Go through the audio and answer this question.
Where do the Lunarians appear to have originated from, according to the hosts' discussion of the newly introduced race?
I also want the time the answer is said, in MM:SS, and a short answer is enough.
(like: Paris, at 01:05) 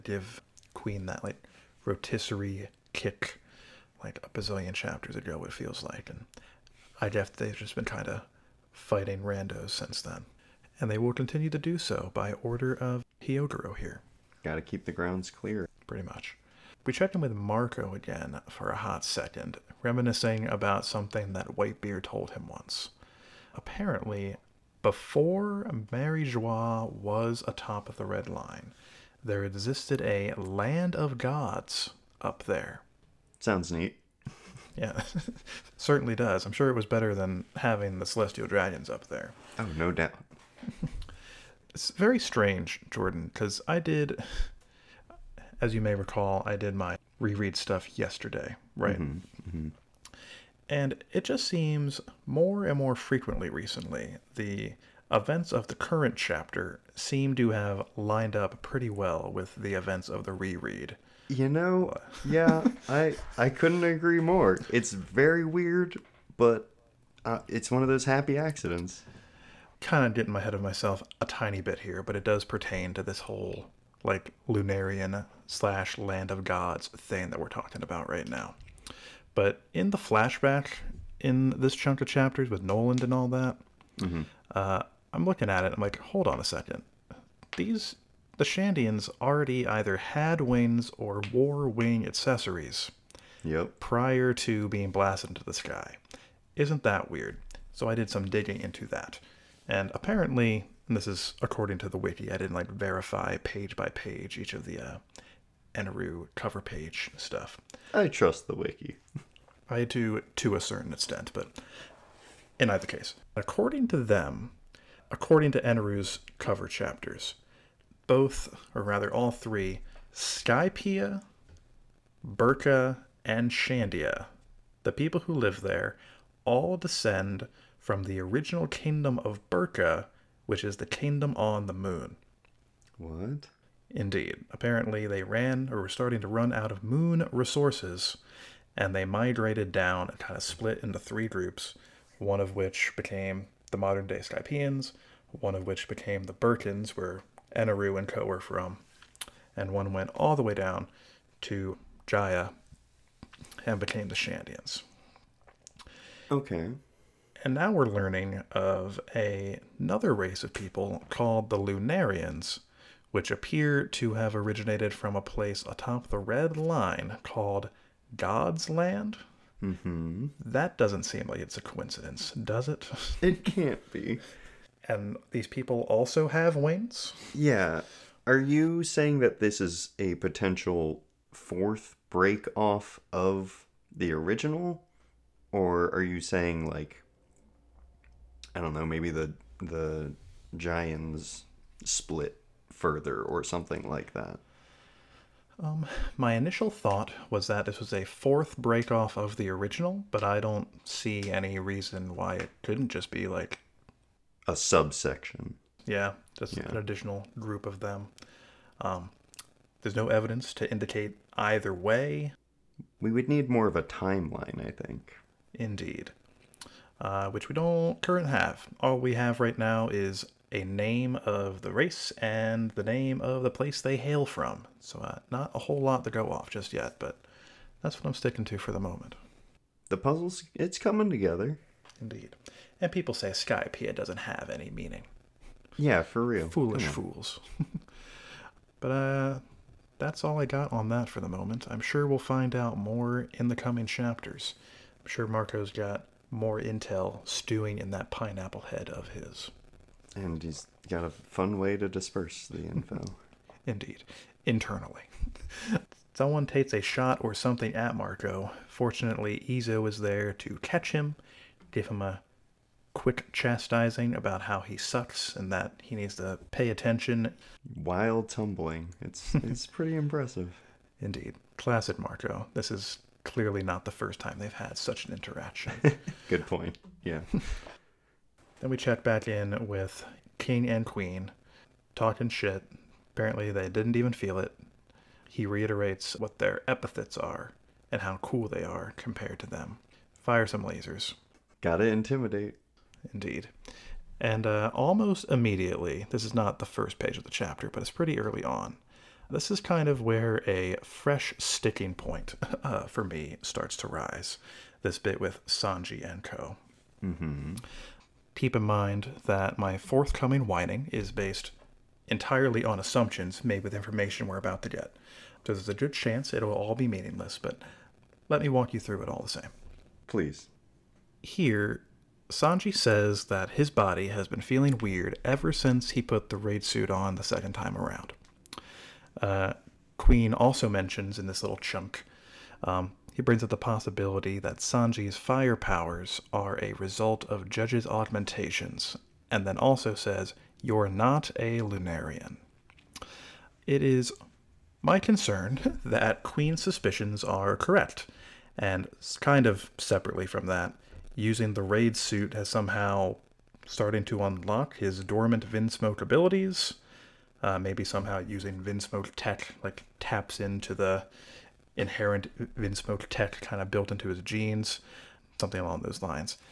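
God's Land, at 02:48.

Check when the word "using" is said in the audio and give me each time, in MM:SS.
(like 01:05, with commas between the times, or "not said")
05:51, 05:58.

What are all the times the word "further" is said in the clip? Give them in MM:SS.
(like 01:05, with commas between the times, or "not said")
03:12.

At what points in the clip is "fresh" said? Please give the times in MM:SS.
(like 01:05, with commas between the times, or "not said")
05:00.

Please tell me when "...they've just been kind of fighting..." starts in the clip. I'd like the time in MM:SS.
00:07.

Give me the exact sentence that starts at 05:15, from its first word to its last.
So there's a good chance it'll all be meaningless, but let me walk you through it all the same.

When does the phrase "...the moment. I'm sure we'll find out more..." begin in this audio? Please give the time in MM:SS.
04:01.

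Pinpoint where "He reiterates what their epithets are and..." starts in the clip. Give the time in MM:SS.
04:45.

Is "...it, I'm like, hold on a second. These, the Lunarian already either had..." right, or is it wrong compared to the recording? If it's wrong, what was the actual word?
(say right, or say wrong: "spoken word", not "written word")
wrong: "Shandians", not "Lunarian".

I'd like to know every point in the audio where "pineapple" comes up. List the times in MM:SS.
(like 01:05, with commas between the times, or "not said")
04:08.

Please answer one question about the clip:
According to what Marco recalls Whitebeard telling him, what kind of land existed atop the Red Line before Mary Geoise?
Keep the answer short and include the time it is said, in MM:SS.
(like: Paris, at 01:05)
A land of gods, at 00:30.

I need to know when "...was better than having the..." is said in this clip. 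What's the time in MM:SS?
00:36.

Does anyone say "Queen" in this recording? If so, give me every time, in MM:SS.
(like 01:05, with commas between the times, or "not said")
00:00, 04:40, 05:29, 05:46.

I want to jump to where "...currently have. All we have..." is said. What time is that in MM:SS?
03:38.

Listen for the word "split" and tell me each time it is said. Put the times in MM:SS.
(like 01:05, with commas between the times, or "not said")
02:20, 03:11.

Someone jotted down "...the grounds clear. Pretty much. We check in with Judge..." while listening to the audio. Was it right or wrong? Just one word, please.
wrong.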